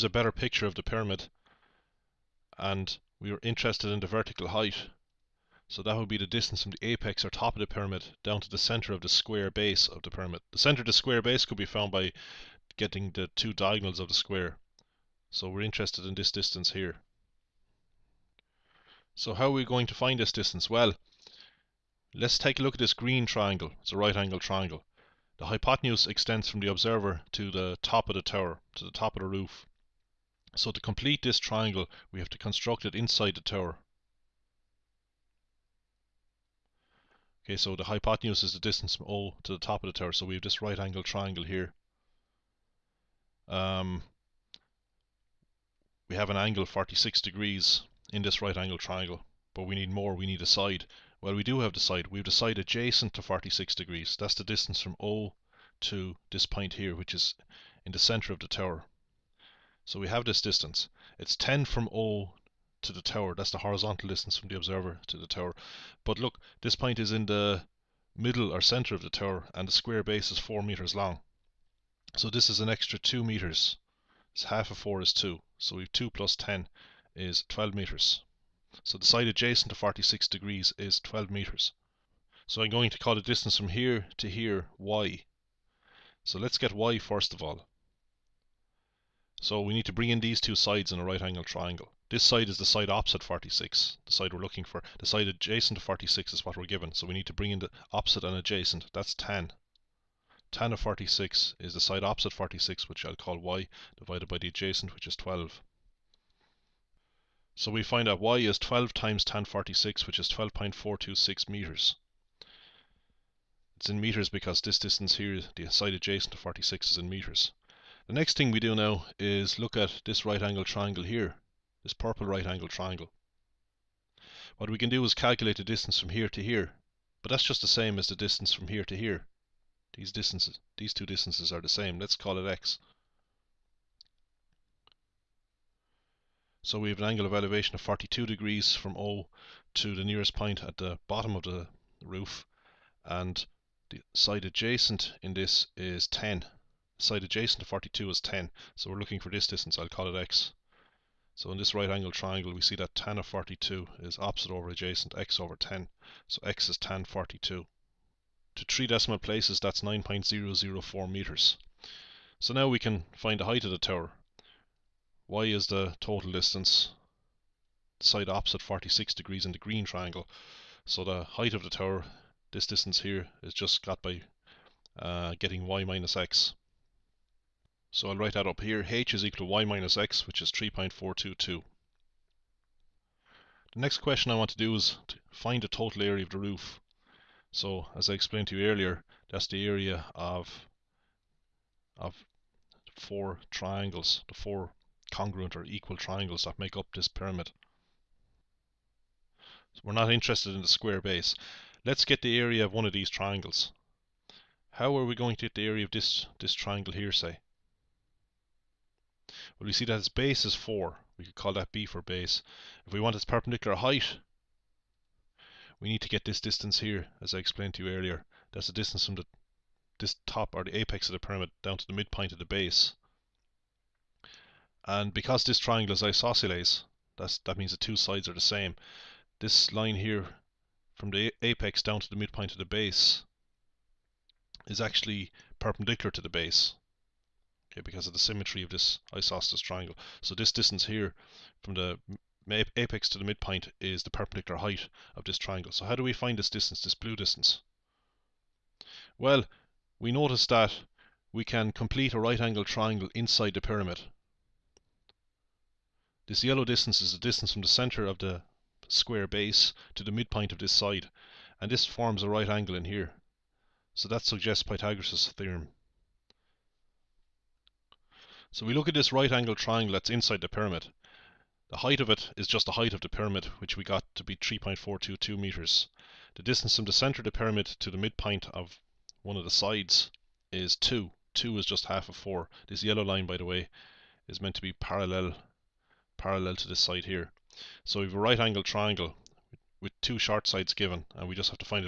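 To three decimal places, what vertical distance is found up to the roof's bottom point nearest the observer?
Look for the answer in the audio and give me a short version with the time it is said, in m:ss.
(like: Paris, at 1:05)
9.004 meters, at 2:39.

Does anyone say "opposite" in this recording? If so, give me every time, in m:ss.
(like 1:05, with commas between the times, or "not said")
1:32, 1:37, 1:42, 2:34, 2:48.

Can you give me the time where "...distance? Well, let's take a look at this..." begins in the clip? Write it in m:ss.
0:20.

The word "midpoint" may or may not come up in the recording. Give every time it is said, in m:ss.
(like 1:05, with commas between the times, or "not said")
3:41, 3:52, 4:03, 4:20, 4:37.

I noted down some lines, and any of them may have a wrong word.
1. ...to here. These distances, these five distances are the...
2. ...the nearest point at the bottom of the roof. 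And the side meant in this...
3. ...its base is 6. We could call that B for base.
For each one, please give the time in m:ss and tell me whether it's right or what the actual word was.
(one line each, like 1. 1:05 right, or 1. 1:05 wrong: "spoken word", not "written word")
1. 2:08 wrong: "two", not "five"
2. 2:19 wrong: "adjacent", not "meant"
3. 3:29 wrong: "4", not "6".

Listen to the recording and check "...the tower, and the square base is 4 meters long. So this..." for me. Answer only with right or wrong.
right.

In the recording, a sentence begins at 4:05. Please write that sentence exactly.
So how do we find this distance, this blue distance?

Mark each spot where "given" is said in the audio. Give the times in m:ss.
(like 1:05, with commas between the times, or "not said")
1:36, 4:50.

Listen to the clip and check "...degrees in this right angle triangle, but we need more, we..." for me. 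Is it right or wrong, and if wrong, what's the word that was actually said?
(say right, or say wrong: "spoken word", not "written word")
right.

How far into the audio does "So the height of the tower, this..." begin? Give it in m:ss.
2:50.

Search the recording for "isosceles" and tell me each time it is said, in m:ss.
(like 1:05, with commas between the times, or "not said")
3:46, 3:59.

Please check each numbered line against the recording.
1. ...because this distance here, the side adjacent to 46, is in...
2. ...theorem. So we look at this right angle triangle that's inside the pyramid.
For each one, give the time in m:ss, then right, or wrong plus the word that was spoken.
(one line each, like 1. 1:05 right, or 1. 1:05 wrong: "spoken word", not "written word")
1. 1:54 right
2. 4:25 right.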